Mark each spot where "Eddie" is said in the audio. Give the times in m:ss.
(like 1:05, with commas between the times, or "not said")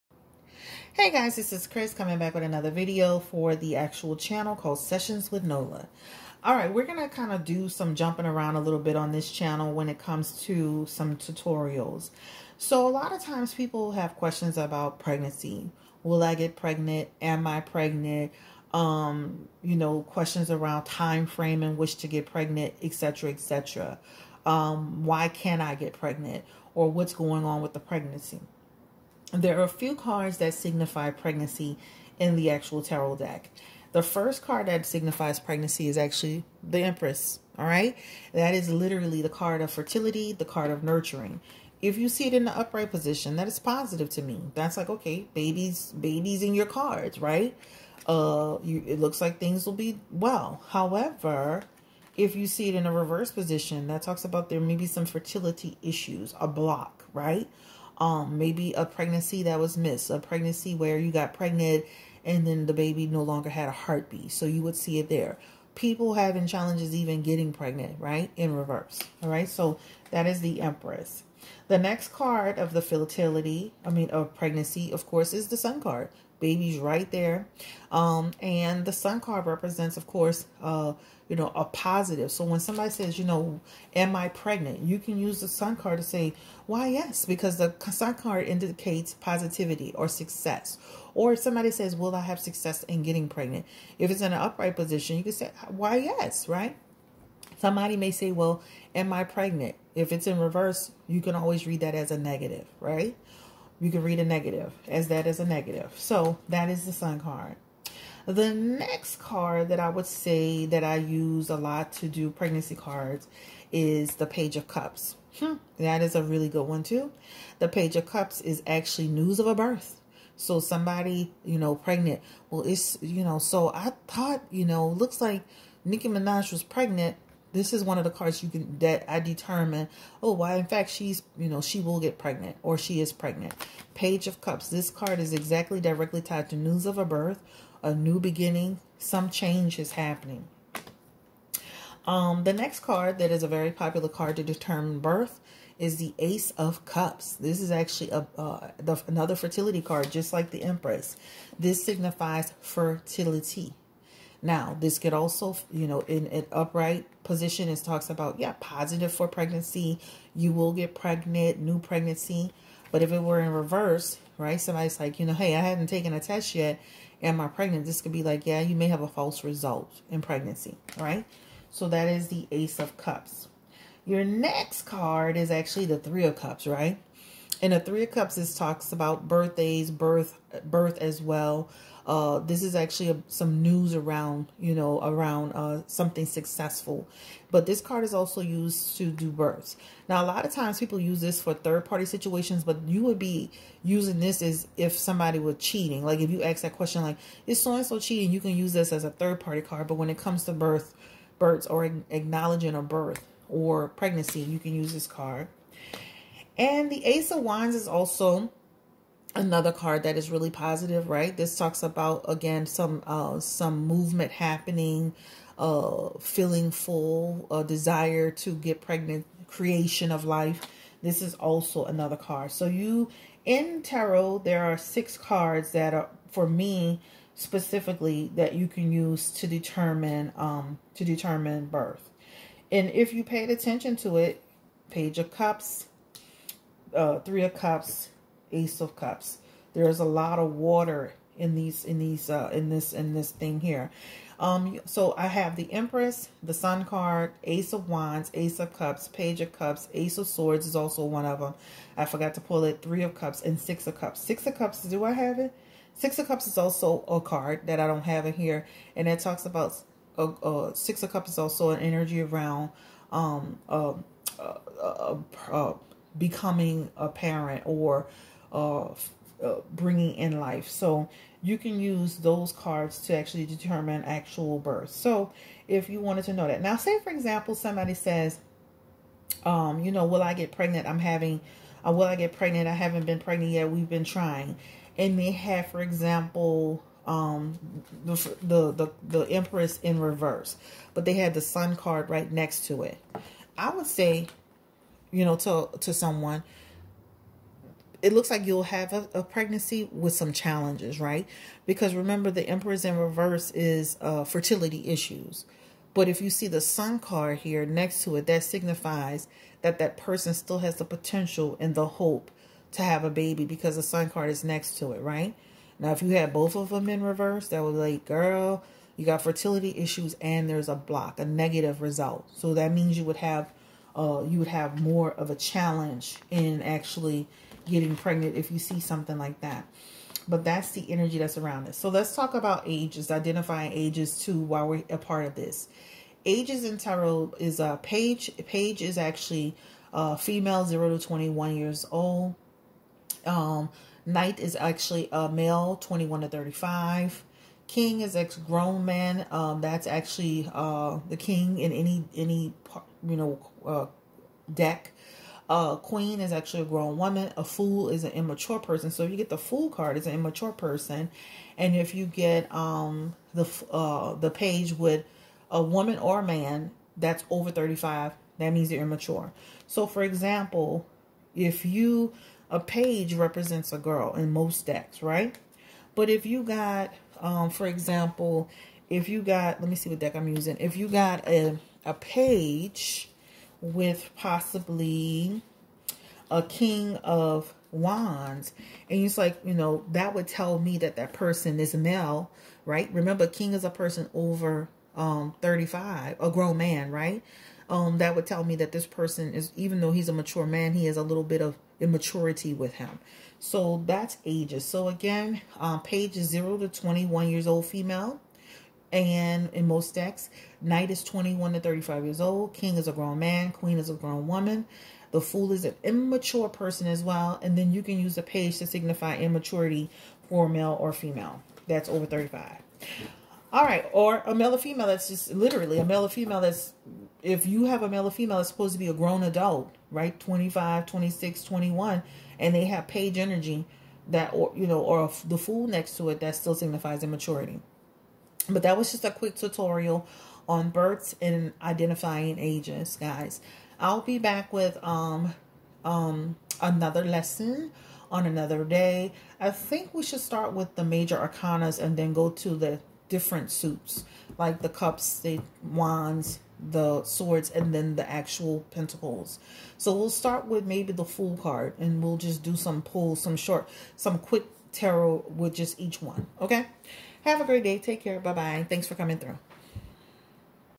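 not said.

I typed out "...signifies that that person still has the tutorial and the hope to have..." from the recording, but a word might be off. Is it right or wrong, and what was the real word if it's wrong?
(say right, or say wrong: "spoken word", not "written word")
wrong: "potential", not "tutorial".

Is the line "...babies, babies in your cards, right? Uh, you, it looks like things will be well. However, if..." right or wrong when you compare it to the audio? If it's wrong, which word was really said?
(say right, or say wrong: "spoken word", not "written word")
right.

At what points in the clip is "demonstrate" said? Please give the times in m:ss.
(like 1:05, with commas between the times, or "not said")
not said.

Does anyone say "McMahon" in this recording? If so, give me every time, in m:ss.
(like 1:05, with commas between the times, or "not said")
not said.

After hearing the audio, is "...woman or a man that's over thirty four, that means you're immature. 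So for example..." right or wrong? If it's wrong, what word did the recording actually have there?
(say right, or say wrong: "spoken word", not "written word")
wrong: "five", not "four".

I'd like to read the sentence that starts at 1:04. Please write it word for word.
So you would see it there.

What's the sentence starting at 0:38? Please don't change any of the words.
That is literally the card of fertility, the card of nurturing.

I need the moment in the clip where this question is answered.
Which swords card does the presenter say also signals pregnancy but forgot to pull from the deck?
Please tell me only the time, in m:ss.
4:09.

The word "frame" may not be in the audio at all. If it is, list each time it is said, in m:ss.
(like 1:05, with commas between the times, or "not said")
0:21.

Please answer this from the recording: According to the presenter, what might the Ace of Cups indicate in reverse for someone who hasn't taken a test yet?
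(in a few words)
a false result.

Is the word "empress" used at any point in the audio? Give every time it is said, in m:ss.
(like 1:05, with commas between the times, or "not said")
0:36, 1:10, 2:30, 4:05, 4:49.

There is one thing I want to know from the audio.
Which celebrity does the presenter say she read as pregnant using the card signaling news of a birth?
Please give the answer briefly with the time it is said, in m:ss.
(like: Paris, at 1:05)
Nicki Minaj, at 2:05.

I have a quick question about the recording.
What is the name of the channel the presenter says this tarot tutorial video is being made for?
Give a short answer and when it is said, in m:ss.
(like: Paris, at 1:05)
Sessions with Nola, at 0:04.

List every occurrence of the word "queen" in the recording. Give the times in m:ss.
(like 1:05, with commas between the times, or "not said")
5:55, 6:53.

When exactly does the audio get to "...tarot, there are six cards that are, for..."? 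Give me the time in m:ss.
3:43.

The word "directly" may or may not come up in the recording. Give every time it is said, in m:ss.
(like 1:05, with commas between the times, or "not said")
2:15.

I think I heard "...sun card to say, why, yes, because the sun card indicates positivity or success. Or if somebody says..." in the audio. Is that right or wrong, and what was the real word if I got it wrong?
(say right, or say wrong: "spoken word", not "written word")
right.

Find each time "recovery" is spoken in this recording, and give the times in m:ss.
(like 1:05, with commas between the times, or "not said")
not said.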